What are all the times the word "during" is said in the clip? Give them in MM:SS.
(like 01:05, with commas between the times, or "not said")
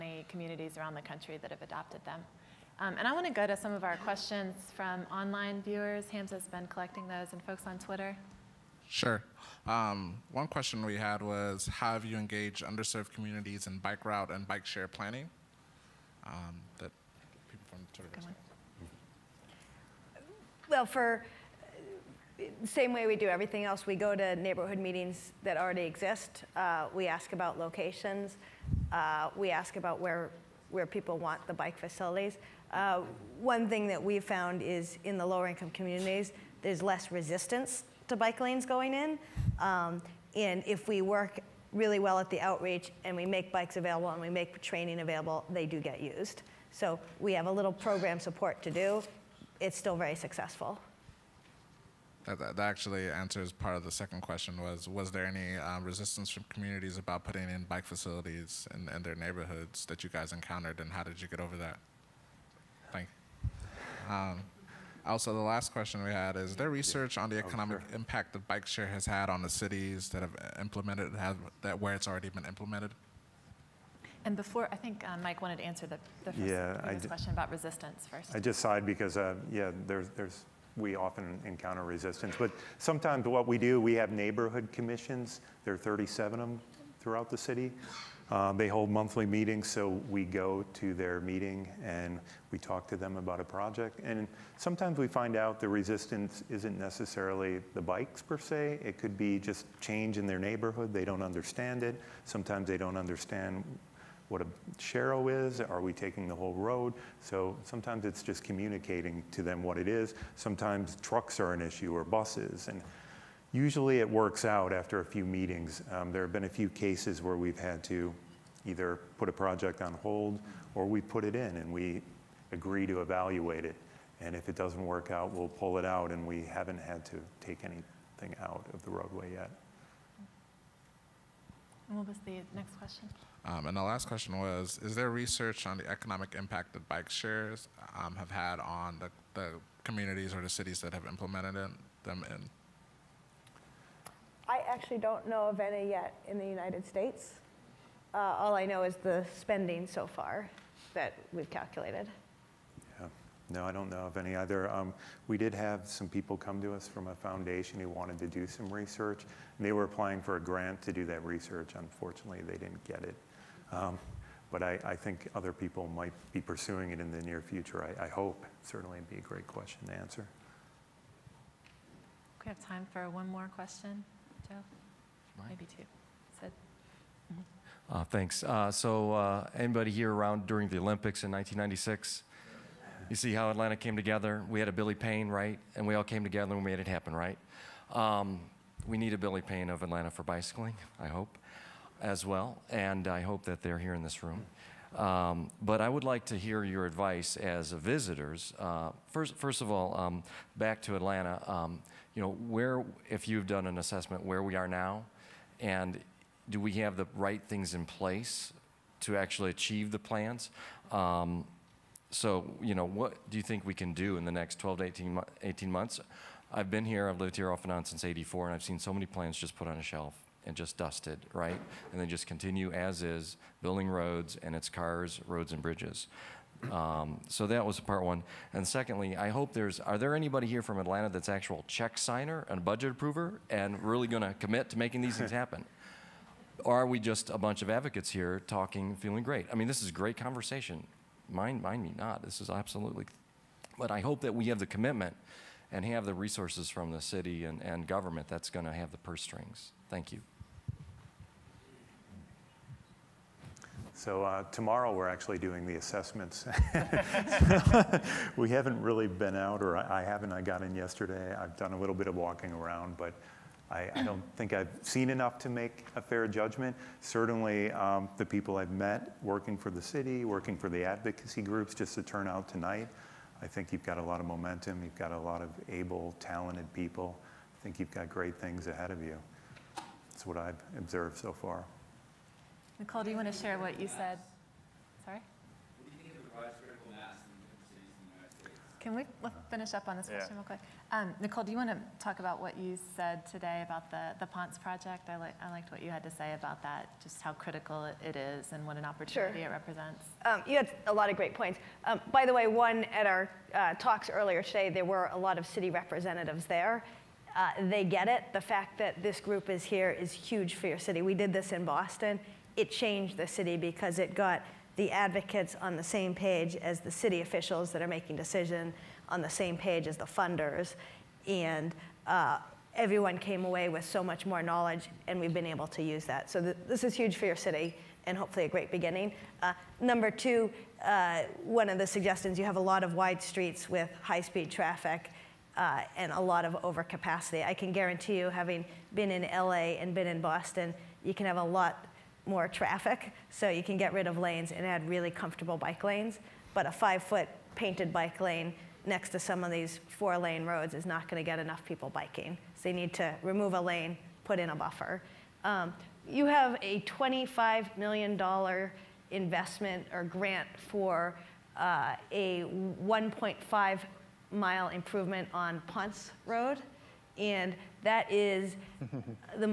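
03:00.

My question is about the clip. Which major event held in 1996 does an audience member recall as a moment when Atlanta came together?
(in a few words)
the Olympics.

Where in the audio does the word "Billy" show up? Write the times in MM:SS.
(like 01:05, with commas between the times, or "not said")
03:04, 03:09.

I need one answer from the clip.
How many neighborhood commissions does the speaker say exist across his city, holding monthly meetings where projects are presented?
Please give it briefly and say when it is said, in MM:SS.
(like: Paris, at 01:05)
37, at 01:25.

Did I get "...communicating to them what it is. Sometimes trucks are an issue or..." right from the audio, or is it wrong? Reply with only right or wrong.
right.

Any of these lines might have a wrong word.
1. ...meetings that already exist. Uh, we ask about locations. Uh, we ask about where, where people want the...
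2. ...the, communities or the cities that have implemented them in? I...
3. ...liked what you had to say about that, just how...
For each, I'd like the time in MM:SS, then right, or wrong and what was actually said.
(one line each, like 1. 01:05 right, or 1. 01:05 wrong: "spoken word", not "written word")
1. 00:24 right
2. 02:19 right
3. 04:55 right.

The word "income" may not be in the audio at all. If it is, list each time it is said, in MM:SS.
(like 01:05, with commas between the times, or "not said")
00:35.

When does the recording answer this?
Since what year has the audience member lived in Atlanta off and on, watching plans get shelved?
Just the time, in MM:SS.
03:38.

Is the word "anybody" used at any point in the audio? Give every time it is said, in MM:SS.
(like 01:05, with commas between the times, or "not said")
02:59, 03:50.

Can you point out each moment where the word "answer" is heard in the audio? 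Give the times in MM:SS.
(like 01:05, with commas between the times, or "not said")
00:53, 01:15, 02:49.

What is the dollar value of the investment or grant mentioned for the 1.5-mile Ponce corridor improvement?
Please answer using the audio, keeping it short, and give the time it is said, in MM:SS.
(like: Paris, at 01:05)
$25 million, at 05:56.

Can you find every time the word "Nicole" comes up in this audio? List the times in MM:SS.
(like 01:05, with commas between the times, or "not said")
04:42, 04:51.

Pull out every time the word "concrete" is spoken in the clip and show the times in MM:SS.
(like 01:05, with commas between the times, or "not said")
not said.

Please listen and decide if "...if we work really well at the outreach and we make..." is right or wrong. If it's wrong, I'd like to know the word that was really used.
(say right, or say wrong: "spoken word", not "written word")
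right.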